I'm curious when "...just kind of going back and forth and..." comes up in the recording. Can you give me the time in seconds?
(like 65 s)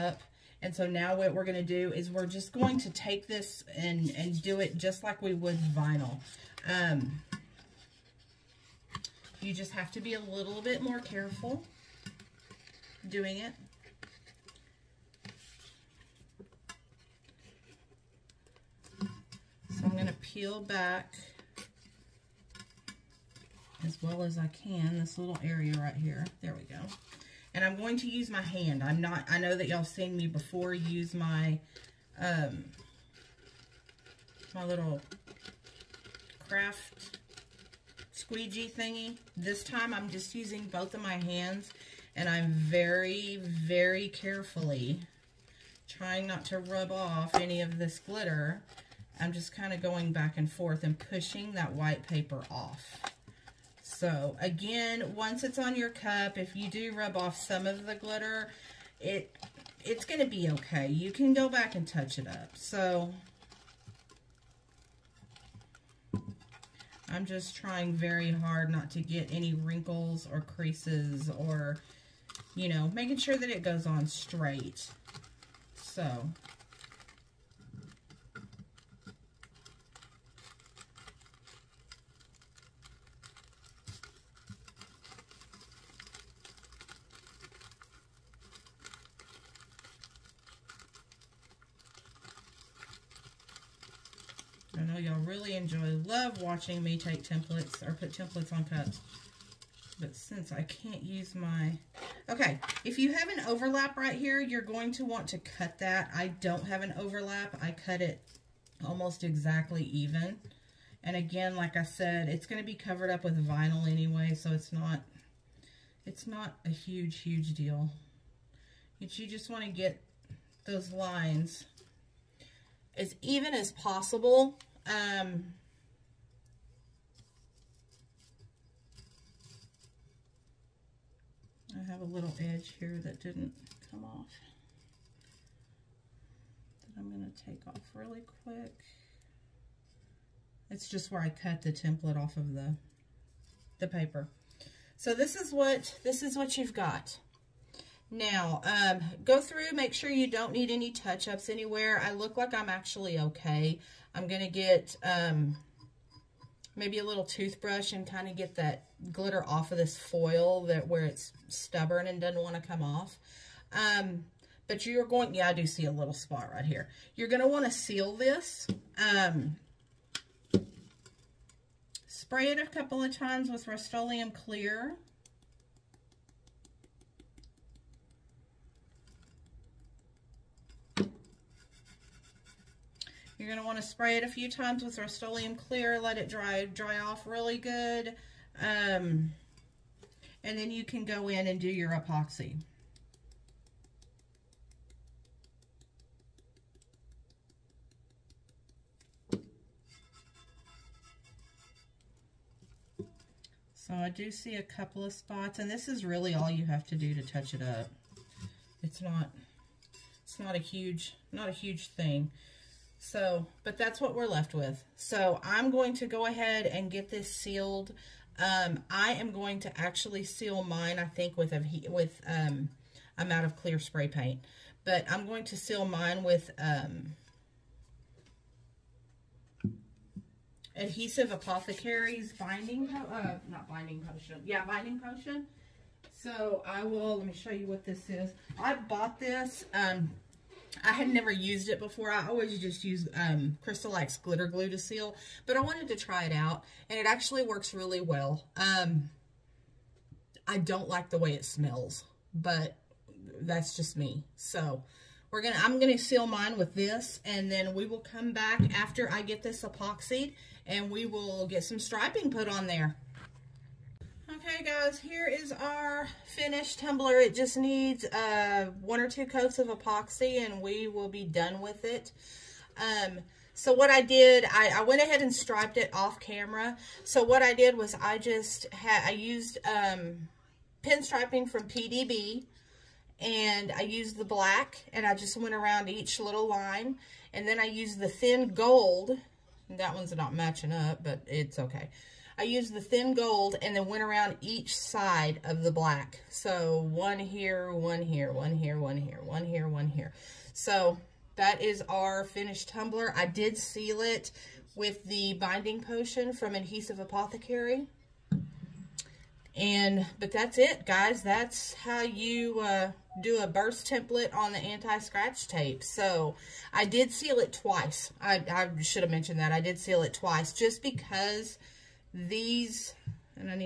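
49 s.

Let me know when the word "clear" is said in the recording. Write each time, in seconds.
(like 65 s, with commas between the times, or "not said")
174 s, 185 s, 223 s.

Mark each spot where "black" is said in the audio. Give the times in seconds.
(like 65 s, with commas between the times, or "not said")
284 s, 295 s.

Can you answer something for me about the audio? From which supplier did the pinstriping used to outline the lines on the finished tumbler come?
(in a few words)
PDB.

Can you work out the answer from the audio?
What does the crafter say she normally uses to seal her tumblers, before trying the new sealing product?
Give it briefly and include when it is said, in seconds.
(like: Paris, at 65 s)
glitter glue, at 244 s.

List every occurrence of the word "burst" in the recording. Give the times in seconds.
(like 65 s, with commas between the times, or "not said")
313 s.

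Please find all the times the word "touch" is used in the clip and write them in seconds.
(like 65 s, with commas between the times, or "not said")
61 s, 150 s, 207 s.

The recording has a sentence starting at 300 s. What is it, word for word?
So that is our finished tumbler.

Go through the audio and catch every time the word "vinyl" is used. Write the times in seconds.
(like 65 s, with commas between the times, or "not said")
5 s, 113 s.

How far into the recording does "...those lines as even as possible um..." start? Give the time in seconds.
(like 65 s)
120 s.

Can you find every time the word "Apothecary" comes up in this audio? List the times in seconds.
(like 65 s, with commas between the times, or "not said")
231 s, 306 s.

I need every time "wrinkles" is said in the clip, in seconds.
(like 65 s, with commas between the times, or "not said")
69 s.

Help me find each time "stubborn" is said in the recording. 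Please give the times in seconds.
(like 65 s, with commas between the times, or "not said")
161 s.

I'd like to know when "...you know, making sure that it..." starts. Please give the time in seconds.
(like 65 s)
72 s.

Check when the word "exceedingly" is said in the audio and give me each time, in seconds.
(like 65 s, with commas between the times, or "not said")
not said.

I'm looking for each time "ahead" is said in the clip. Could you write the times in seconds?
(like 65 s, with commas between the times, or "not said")
216 s, 275 s.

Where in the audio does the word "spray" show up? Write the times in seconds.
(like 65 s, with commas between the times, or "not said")
172 s, 183 s, 223 s.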